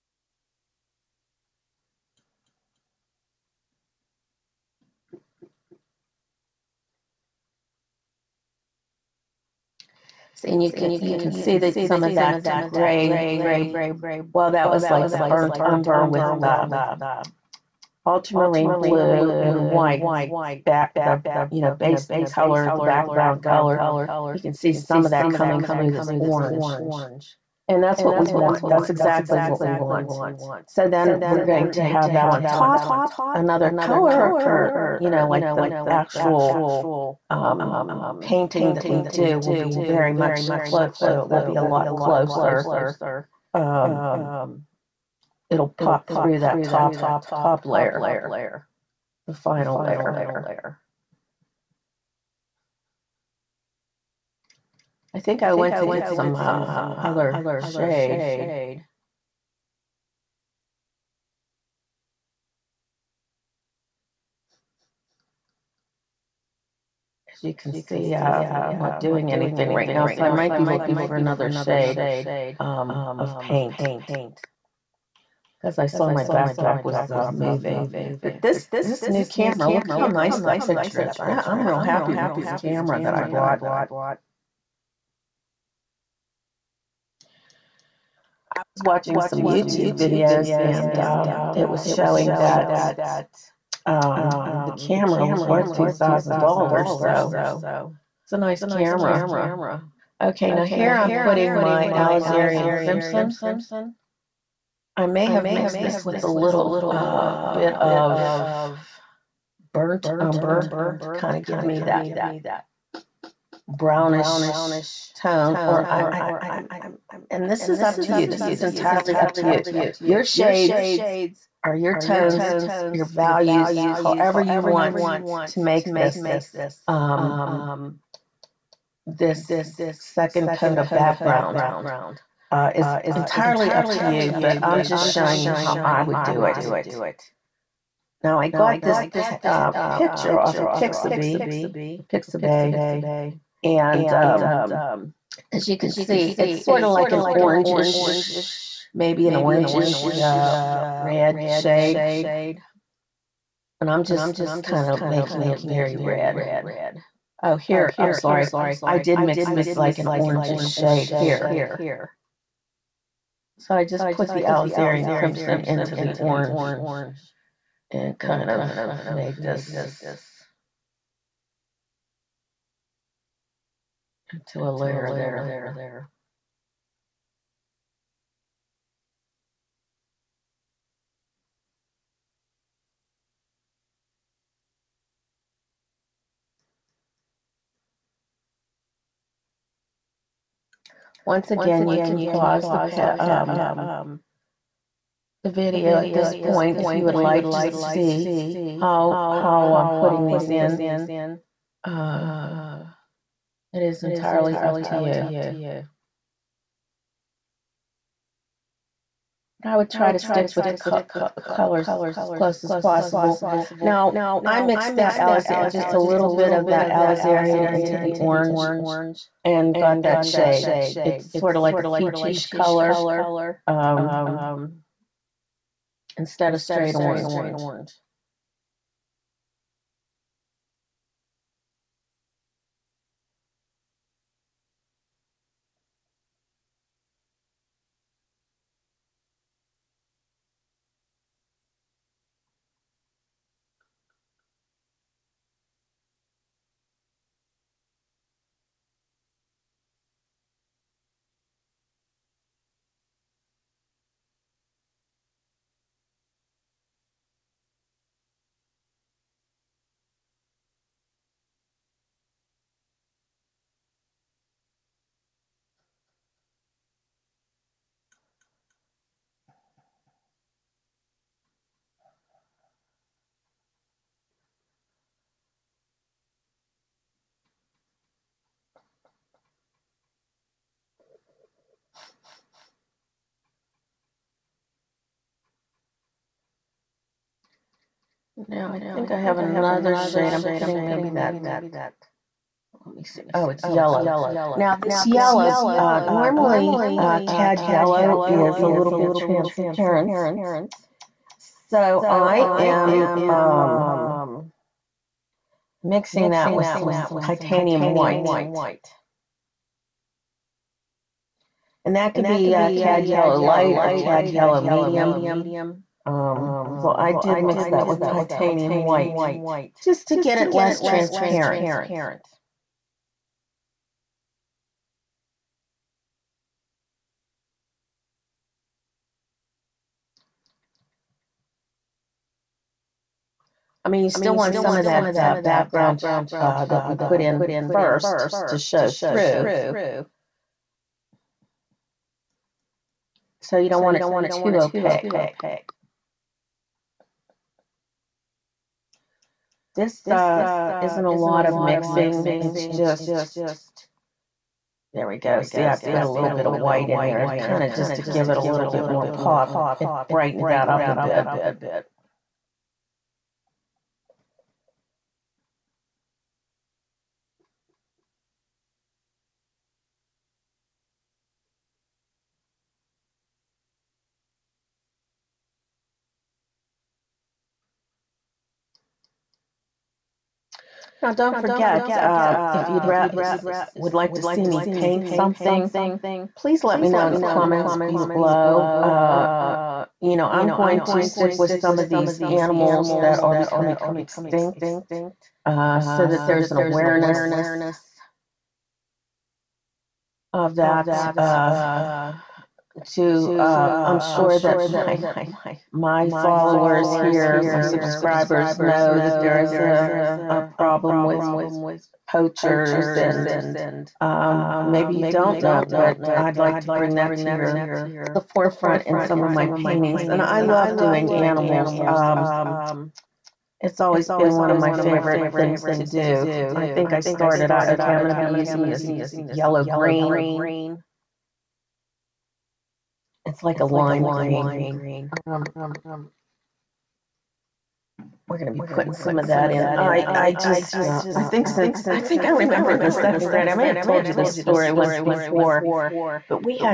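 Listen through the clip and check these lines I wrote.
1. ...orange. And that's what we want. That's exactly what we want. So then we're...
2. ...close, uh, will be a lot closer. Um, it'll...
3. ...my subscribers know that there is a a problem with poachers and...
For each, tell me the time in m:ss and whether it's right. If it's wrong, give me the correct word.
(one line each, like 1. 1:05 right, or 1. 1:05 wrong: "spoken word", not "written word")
1. 0:26 right
2. 0:40 right
3. 6:47 right.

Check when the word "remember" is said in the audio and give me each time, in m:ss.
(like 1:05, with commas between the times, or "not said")
7:22.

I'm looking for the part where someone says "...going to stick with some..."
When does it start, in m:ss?
6:30.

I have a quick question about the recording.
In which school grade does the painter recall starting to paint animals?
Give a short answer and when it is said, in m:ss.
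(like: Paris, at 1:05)
Second grade, at 7:22.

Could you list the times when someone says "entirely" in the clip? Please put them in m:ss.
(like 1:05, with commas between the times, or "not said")
1:58, 2:13, 3:24.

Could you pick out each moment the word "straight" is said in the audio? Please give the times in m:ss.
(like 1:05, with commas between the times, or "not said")
3:46.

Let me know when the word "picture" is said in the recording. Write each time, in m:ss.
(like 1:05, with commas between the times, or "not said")
1:20, 2:19.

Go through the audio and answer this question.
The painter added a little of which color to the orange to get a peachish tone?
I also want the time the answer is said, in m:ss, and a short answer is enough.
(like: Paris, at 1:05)
Alizarin crimson, at 2:44.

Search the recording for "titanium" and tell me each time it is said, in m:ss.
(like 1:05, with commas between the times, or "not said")
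5:07, 5:18.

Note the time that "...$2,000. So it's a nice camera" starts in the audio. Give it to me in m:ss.
1:35.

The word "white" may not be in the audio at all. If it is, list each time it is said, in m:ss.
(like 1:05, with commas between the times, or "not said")
0:19, 5:07, 5:18, 5:56.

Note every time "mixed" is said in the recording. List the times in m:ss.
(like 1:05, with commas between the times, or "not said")
1:45, 3:34.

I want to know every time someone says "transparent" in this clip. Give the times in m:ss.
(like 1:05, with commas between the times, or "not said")
4:59, 5:20.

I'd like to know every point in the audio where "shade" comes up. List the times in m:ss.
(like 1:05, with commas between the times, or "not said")
0:57, 1:11, 2:00, 2:31, 2:40, 3:40, 4:49.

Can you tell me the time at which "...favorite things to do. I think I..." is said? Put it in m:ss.
7:04.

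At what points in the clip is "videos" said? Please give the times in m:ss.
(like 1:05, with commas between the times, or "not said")
1:29, 3:15.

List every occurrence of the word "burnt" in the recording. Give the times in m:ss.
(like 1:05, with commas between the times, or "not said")
0:15, 1:49.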